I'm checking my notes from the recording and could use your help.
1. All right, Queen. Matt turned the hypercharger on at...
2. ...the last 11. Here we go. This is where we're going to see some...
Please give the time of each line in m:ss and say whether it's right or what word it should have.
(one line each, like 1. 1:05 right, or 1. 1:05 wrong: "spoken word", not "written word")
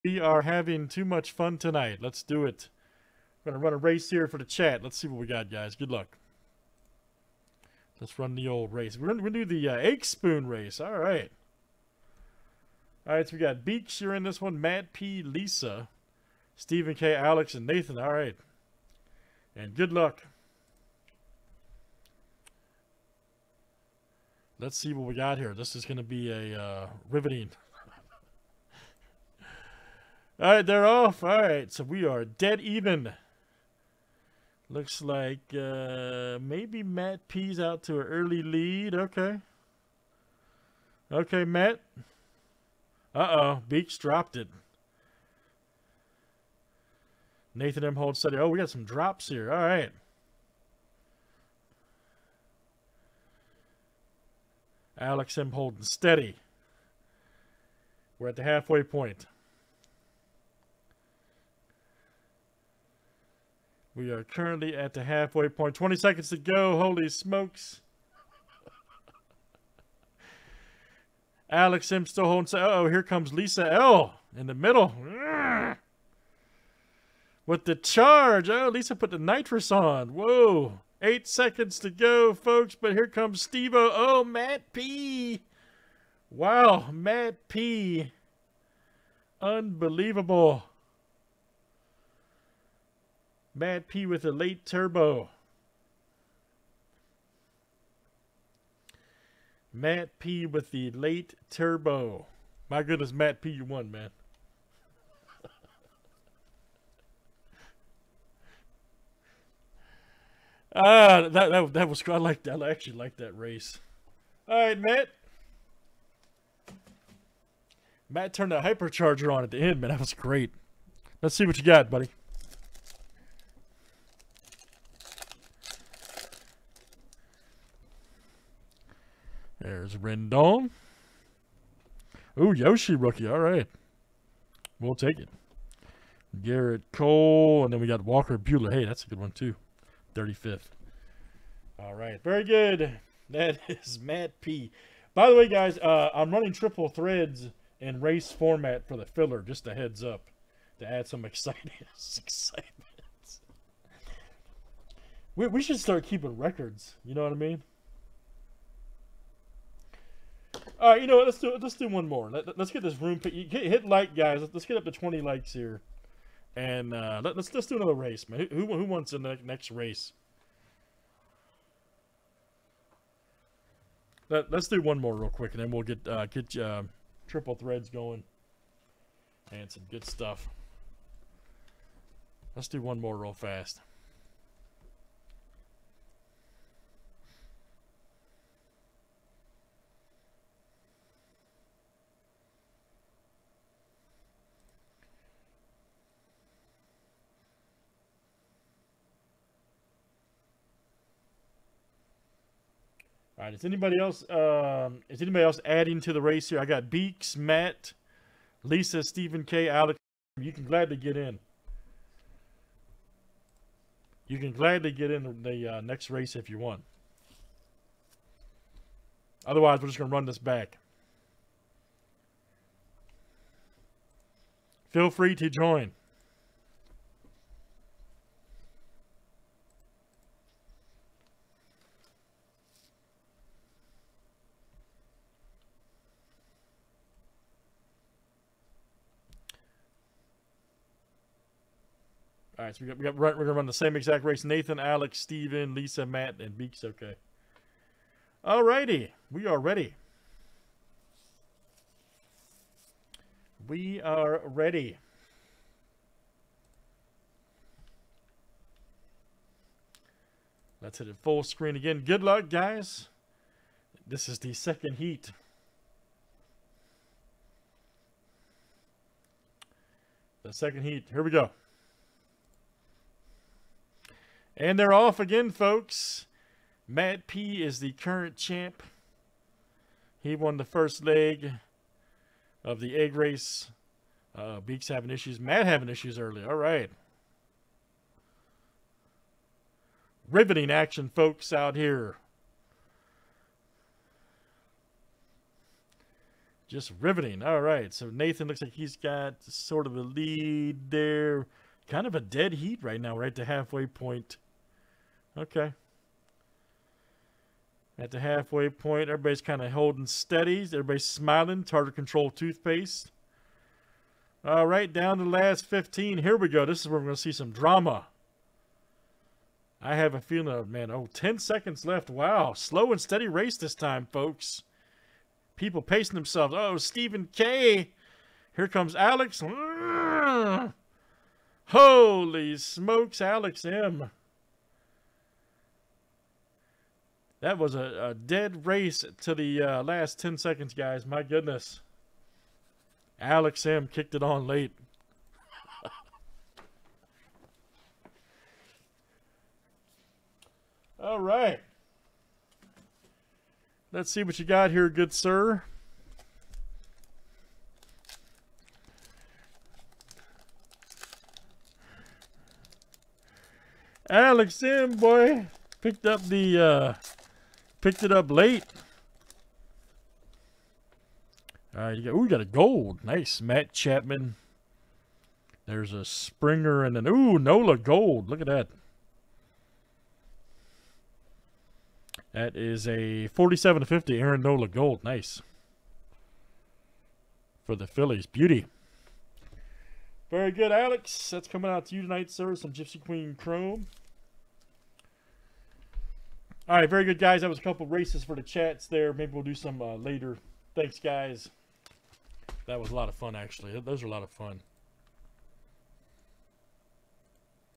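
1. 1:54 wrong: "Matt", not "Queen"
2. 5:15 wrong: "15", not "11".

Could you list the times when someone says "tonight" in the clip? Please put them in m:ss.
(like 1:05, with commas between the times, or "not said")
0:01, 6:32.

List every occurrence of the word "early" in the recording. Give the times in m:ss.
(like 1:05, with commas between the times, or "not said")
0:38, 4:46.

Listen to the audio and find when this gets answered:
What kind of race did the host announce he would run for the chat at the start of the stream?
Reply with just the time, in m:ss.
0:09.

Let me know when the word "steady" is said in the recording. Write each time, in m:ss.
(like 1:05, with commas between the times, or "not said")
0:55, 5:10, 5:22.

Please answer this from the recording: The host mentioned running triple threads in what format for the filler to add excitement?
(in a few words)
race format.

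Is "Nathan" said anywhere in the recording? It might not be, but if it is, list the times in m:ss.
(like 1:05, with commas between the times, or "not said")
0:17, 0:47, 4:04, 4:58.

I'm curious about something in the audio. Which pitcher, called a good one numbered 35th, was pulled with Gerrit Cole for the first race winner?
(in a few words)
Walker Buehler.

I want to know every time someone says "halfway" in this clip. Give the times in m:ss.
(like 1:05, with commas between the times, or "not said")
0:58, 1:05, 5:03, 5:08.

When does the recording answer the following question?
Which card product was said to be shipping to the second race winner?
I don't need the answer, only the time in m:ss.
6:32.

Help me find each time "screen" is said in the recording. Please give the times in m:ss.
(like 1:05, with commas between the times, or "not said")
4:21.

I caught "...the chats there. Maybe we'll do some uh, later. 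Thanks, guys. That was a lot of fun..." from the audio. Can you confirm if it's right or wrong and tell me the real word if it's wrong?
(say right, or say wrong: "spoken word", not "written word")
right.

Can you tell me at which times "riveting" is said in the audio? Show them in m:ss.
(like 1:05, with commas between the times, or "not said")
0:27, 4:50, 4:56.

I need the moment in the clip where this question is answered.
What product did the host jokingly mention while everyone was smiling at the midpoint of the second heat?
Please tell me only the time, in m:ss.
5:11.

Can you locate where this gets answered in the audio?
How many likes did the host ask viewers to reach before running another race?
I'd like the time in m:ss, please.
2:44.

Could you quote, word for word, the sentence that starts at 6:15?
There's a Springer and an, ooh, Nola gold.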